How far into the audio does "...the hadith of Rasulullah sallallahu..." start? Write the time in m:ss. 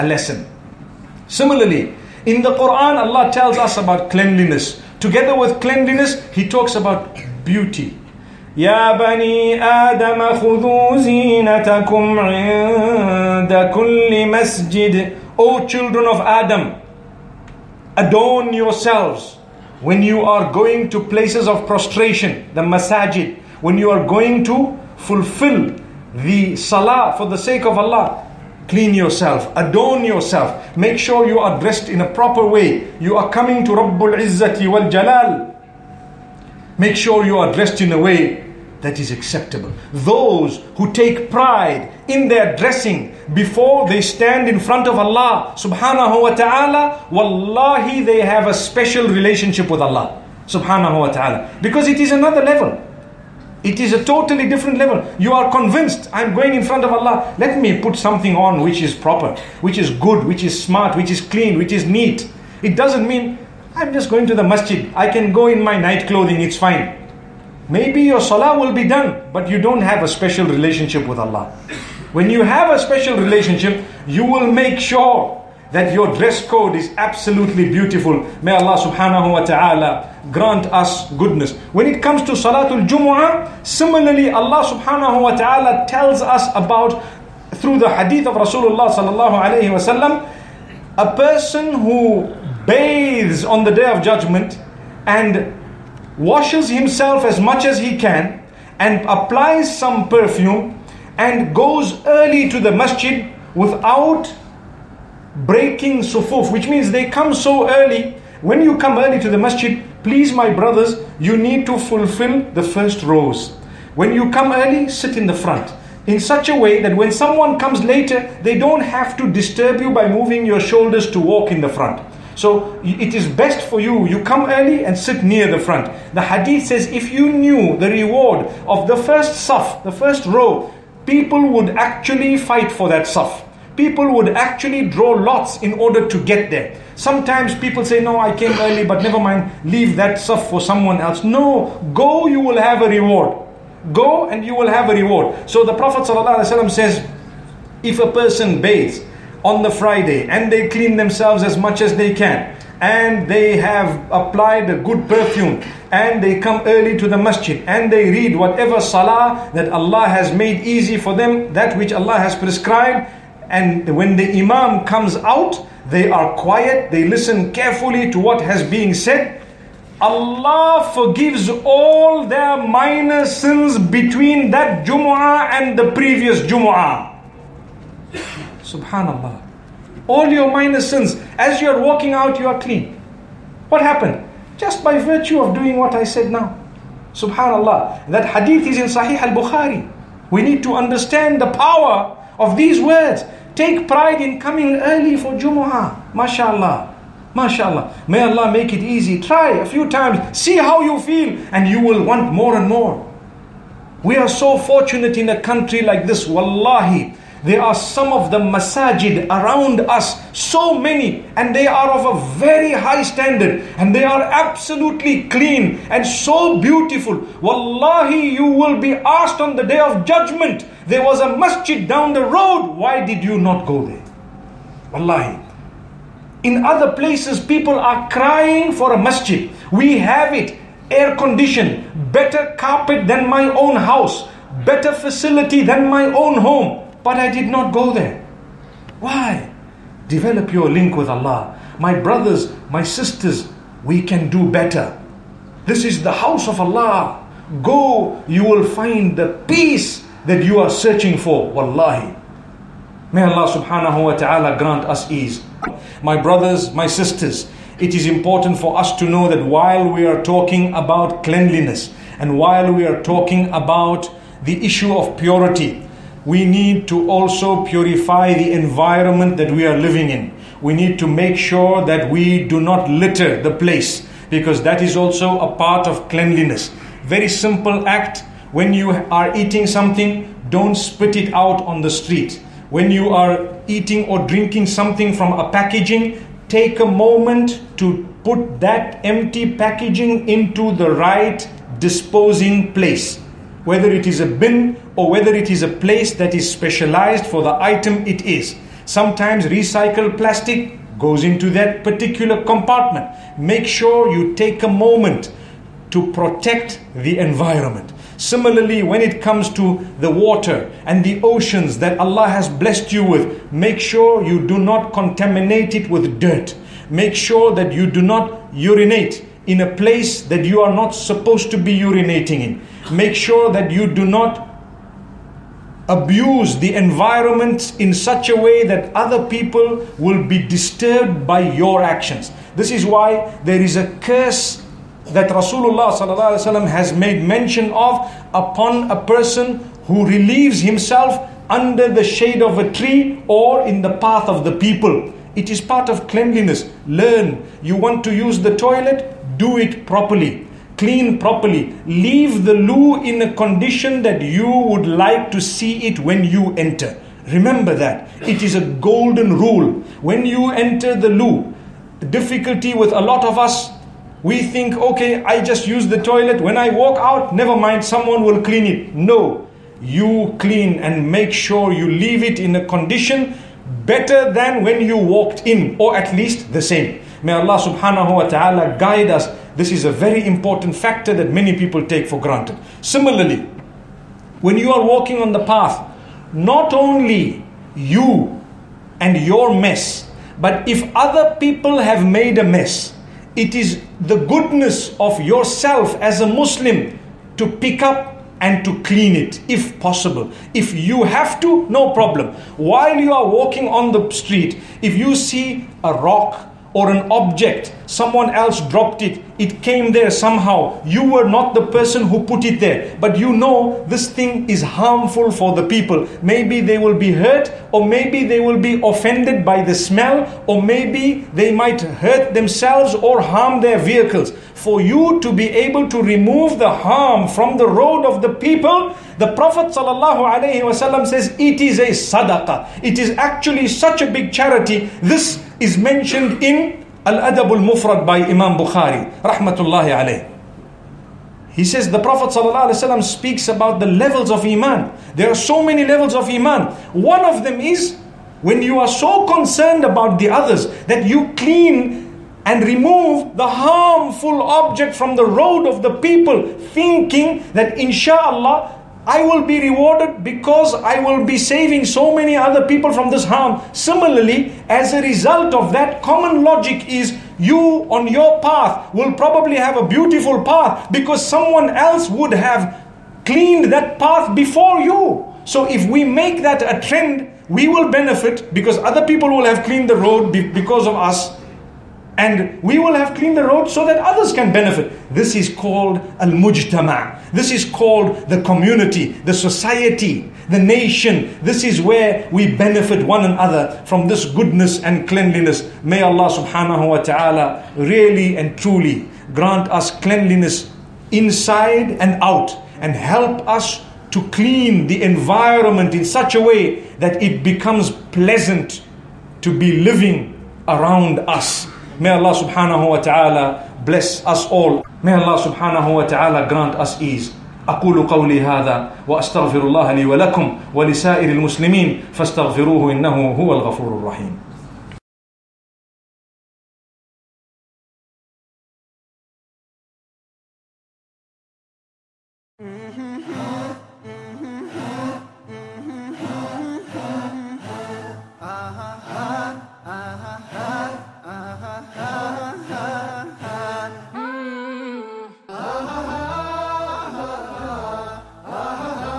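1:27.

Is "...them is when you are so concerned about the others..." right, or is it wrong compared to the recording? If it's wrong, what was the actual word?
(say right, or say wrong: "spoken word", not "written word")
right.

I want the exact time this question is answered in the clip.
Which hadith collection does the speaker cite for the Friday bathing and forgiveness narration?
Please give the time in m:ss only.
3:08.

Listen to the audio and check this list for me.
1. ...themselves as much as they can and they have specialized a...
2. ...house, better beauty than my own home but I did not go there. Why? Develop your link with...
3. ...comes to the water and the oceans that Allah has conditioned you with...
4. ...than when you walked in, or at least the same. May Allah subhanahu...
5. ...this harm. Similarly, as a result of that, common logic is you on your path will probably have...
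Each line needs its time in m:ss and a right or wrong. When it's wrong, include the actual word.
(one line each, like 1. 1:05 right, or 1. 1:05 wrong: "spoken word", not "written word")
1. 2:30 wrong: "applied", not "specialized"
2. 3:53 wrong: "facility", not "beauty"
3. 5:09 wrong: "blessed", not "conditioned"
4. 6:14 right
5. 7:43 right.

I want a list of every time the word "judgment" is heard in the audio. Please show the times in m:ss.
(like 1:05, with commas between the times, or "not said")
1:34, 3:40.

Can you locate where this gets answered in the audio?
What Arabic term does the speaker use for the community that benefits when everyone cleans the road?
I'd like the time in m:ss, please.
8:06.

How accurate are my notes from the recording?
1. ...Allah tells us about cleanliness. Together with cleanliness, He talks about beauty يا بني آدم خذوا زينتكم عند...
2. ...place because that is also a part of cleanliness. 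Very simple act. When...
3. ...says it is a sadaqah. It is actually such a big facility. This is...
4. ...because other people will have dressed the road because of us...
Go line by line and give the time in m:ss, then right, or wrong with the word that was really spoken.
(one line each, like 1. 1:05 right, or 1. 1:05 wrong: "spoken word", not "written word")
1. 0:03 right
2. 4:33 right
3. 7:11 wrong: "charity", not "facility"
4. 7:58 wrong: "cleaned", not "dressed".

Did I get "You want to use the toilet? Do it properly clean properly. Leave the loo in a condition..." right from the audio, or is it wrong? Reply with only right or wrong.
right.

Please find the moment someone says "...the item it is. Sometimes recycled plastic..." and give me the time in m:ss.
4:57.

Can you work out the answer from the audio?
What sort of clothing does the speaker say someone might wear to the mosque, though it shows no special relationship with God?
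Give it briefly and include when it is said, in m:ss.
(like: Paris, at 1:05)
Night clothing, at 1:05.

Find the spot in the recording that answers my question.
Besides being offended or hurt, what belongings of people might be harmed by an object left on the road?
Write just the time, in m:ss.
7:03.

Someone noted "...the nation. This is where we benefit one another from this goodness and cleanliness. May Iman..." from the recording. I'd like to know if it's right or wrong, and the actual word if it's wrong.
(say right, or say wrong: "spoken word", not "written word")
wrong: "Allah", not "Iman".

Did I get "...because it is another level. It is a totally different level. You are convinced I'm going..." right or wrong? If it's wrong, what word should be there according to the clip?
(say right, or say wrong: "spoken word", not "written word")
right.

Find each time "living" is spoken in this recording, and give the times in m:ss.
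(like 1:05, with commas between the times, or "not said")
4:29, 8:29.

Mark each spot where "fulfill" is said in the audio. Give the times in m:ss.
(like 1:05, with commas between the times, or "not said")
0:24, 1:51.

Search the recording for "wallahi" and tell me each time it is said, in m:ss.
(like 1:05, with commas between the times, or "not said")
0:47, 3:26, 3:37, 3:44, 4:11.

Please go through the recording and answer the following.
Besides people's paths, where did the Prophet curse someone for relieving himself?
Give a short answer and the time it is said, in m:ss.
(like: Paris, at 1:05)
Shade of a tree, at 5:42.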